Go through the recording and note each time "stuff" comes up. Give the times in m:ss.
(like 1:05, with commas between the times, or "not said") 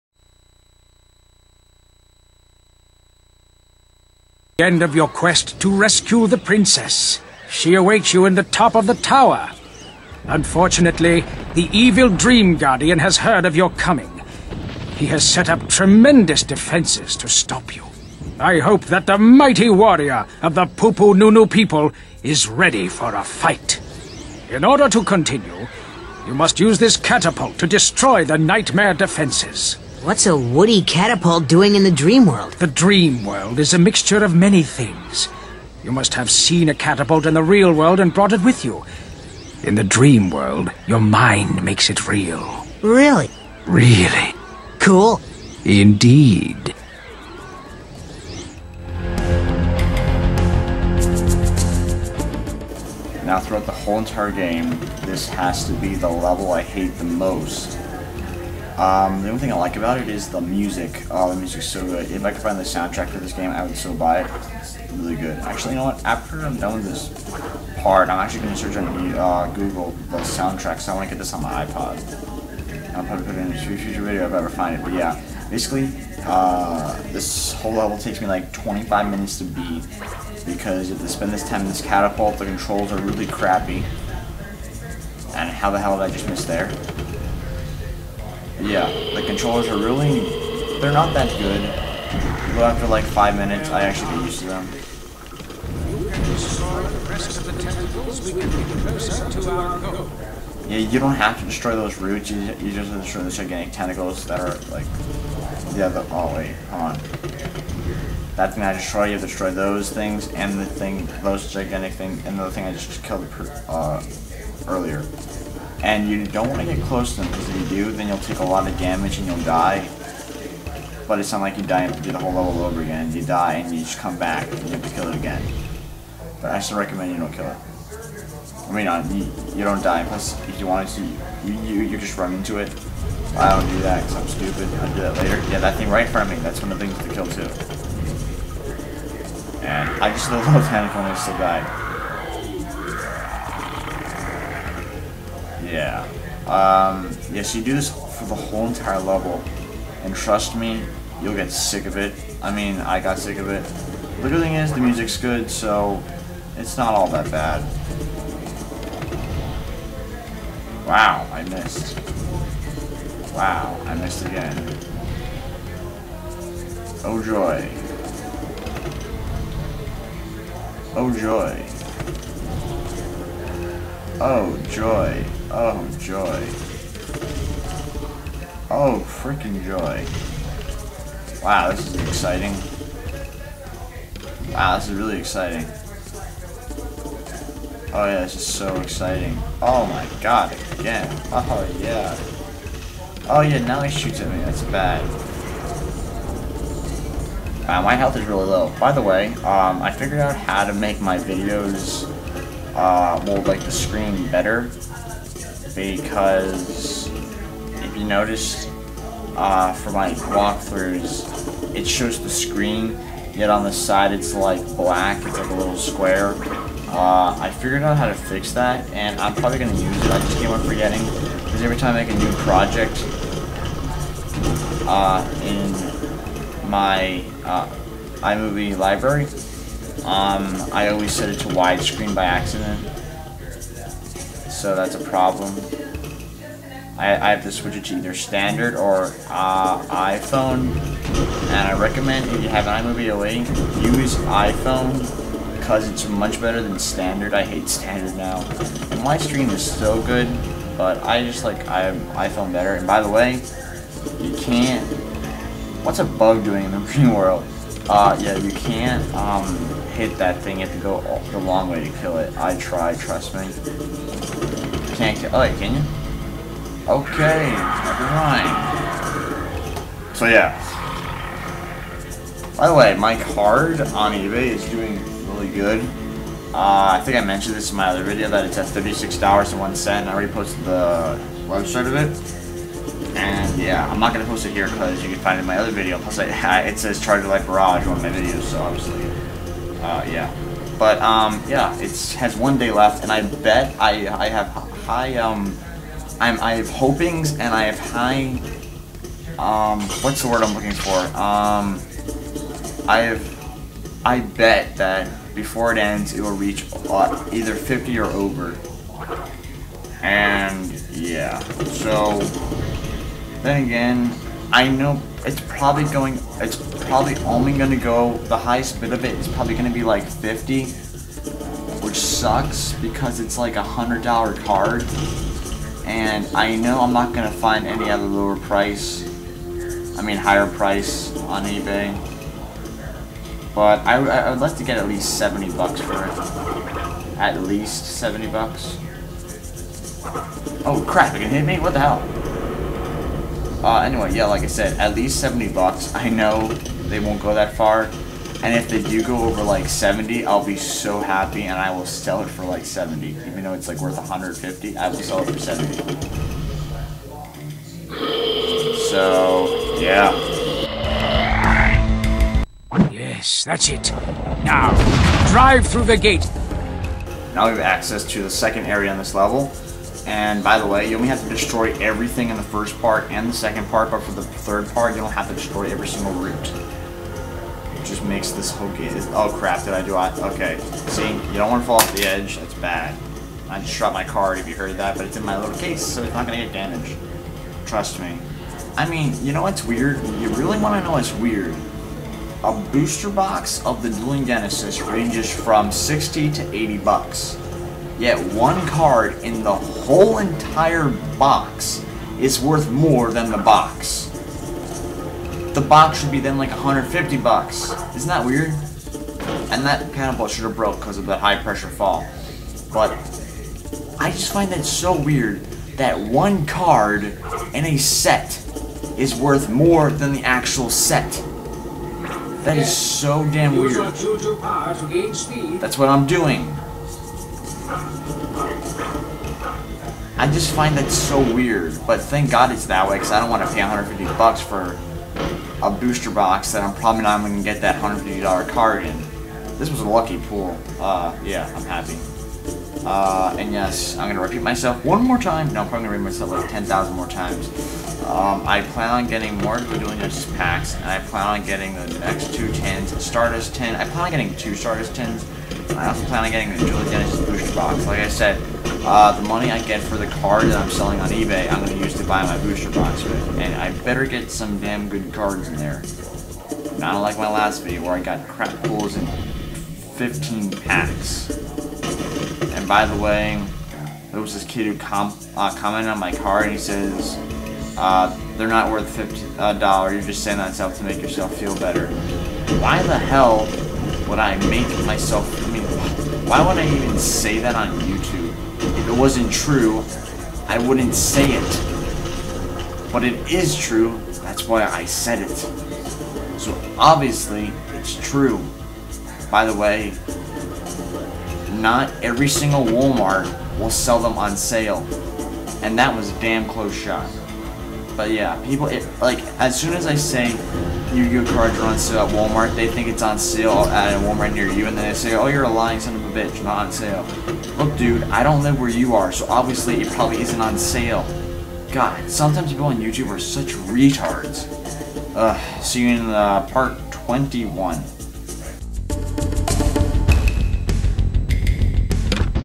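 8:00.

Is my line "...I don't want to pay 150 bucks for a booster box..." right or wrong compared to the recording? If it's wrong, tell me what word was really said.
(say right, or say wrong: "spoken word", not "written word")
right.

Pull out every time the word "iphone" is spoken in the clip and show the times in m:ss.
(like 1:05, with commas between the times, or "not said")
3:59, 4:04, 4:12.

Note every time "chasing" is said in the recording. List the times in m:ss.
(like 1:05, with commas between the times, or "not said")
not said.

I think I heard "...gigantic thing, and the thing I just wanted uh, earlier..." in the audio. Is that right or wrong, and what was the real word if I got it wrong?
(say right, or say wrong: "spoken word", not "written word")
wrong: "killed", not "wanted".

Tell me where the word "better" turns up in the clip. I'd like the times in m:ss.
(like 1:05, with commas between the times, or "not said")
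3:24, 4:06, 4:12, 7:43, 8:01.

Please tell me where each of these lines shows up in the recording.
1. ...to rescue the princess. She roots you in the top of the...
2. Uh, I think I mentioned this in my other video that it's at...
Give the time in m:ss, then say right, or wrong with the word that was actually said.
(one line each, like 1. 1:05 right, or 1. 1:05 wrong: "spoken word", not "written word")
1. 0:05 wrong: "awaits", not "roots"
2. 4:36 right.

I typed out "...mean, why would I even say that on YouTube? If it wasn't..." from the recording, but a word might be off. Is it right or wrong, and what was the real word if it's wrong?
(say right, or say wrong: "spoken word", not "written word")
right.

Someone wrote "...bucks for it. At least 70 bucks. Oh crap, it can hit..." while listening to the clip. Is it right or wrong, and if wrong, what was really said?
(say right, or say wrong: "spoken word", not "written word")
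right.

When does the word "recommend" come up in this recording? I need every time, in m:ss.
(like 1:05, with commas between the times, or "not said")
2:06, 4:01.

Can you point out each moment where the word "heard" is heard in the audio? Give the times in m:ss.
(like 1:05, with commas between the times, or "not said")
0:13, 6:24.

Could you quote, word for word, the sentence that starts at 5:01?
Um, I have I bet that before it ends, it will reach uh, either 50 or over.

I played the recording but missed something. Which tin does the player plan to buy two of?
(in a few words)
Stardust tin.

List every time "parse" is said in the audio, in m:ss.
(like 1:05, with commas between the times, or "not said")
not said.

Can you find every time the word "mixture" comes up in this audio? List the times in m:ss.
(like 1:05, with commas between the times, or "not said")
0:33.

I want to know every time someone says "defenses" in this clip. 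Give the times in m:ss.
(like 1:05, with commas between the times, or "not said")
0:16, 0:28.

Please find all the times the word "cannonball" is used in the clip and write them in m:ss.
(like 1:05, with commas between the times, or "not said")
6:49.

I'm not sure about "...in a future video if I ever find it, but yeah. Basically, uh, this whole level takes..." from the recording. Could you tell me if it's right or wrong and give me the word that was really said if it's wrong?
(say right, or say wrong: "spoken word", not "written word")
right.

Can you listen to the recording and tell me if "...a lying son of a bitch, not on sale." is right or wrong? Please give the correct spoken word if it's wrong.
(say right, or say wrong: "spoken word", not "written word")
right.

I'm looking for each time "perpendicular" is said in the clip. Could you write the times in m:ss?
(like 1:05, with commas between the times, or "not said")
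not said.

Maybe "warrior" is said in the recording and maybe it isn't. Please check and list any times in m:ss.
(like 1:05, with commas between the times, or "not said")
0:19.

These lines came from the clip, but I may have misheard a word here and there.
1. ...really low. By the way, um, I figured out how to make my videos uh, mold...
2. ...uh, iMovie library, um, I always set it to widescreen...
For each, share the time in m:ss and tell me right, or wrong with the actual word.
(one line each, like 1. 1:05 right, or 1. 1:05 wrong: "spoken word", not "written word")
1. 3:18 right
2. 3:47 right.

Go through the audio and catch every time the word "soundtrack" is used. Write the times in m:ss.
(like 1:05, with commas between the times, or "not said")
1:02, 1:10.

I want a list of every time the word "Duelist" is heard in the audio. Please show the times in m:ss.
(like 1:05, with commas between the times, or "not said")
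6:33, 7:29, 7:36.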